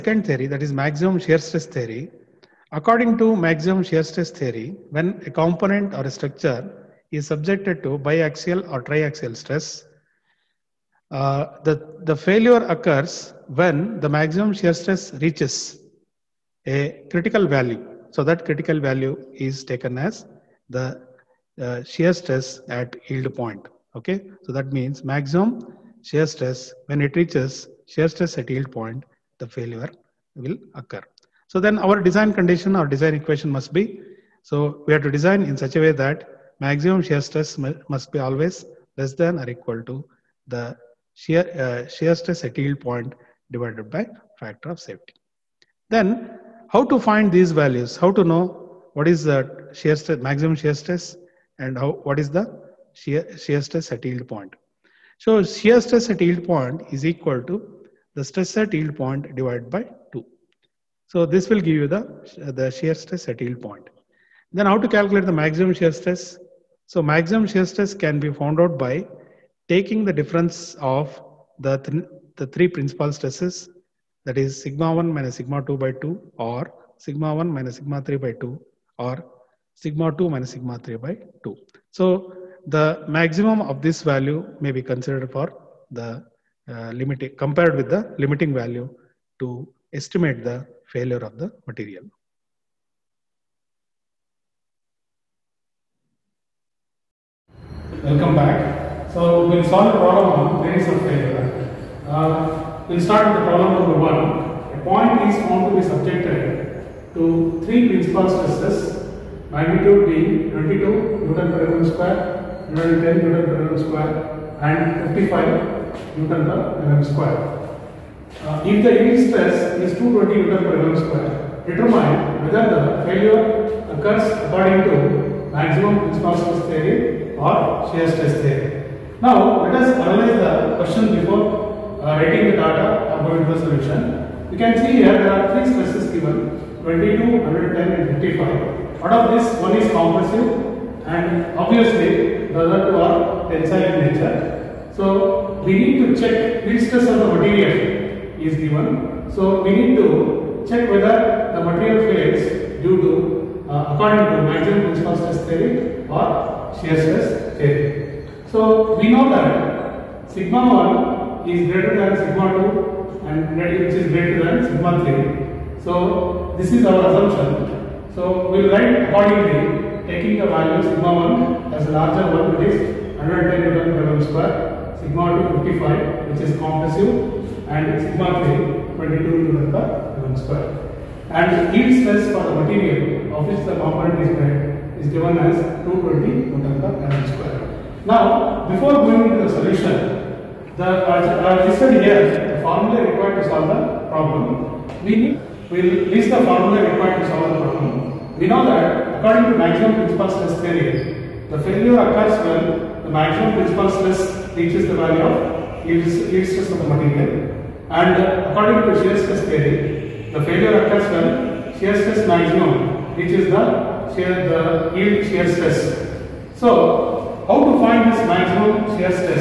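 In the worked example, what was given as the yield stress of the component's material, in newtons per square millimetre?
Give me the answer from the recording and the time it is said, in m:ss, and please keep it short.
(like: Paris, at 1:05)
220, at 3:05.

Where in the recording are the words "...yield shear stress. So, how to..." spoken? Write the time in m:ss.
3:34.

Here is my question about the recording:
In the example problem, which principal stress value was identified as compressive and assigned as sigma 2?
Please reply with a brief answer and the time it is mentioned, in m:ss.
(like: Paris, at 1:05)
55, at 2:54.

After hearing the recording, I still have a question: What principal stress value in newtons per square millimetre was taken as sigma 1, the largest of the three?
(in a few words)
110.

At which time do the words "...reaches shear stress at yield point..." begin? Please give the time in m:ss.
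0:27.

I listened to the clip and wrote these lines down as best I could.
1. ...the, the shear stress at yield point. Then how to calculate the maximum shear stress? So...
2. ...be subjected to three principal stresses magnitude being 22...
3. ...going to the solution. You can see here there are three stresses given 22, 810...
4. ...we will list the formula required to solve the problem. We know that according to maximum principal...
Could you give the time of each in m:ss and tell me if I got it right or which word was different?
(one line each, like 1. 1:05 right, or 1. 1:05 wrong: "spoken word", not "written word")
1. 1:01 right
2. 1:45 right
3. 2:13 wrong: "110", not "810"
4. 3:15 right.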